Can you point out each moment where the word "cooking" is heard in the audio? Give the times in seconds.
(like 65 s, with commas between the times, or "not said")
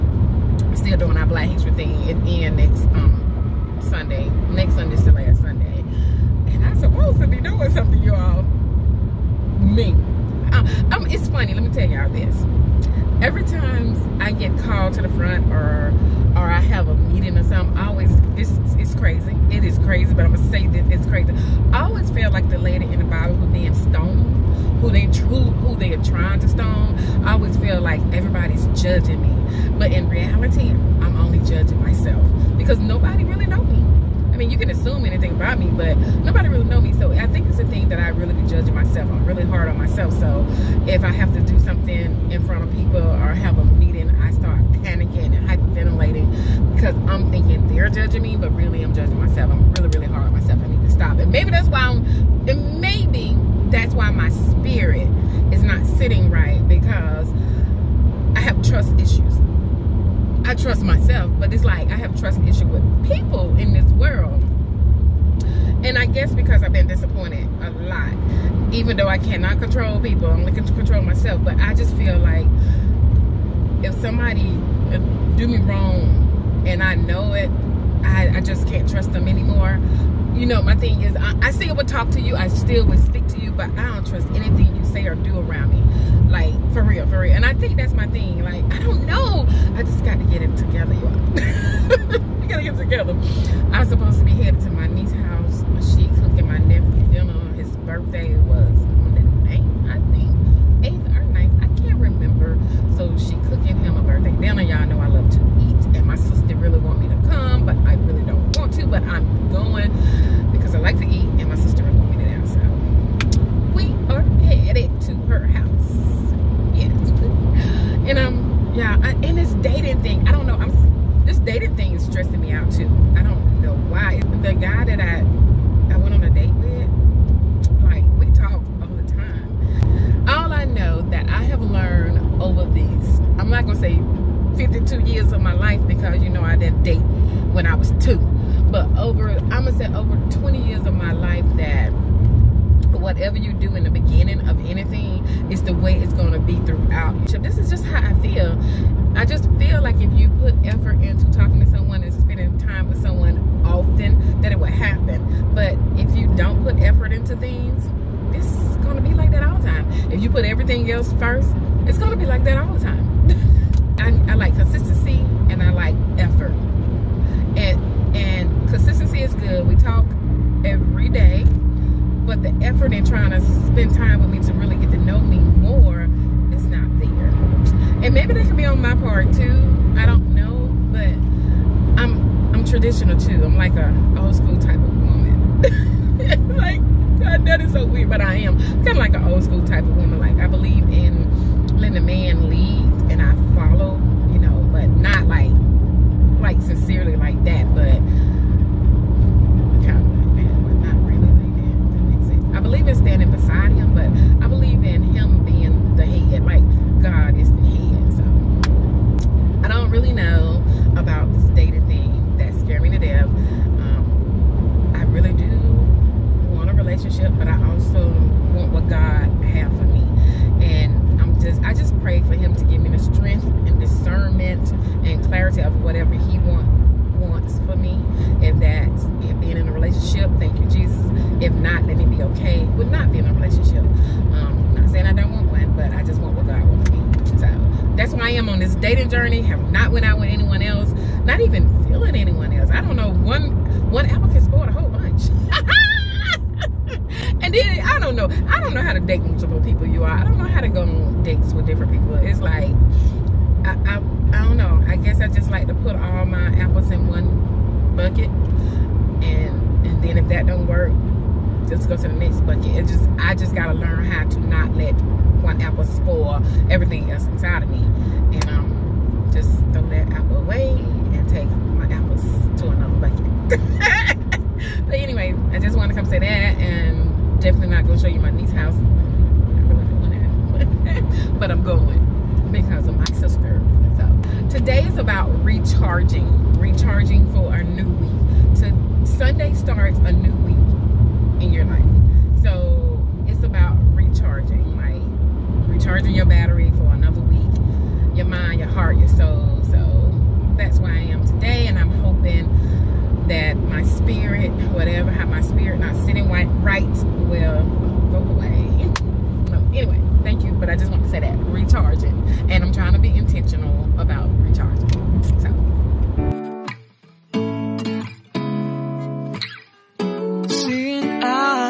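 96 s, 103 s.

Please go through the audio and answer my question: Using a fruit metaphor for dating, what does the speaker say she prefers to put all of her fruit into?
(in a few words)
One bucket.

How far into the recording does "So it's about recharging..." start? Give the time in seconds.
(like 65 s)
292 s.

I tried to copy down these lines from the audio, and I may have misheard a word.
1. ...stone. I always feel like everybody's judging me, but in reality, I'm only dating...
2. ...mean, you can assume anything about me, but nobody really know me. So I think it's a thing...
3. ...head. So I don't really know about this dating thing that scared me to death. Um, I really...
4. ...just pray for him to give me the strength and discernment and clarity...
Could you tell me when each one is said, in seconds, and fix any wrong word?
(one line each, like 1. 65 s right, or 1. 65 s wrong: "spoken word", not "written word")
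1. 26 s wrong: "judging", not "dating"
2. 34 s right
3. 207 s right
4. 221 s right.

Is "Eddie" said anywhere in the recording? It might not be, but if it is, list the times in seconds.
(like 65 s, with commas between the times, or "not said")
not said.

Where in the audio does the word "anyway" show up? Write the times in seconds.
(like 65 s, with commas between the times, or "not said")
274 s, 309 s.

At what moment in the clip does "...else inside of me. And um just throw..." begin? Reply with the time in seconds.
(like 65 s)
267 s.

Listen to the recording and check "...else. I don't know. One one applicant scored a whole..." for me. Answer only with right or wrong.
right.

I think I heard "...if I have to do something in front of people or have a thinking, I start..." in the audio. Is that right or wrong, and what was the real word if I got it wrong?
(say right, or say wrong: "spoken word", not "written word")
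wrong: "meeting", not "thinking".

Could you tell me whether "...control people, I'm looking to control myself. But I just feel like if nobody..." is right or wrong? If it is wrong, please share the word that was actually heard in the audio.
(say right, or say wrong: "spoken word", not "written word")
wrong: "somebody", not "nobody".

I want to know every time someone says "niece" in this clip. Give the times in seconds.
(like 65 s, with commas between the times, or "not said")
94 s, 278 s.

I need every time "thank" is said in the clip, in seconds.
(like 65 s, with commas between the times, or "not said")
230 s, 310 s.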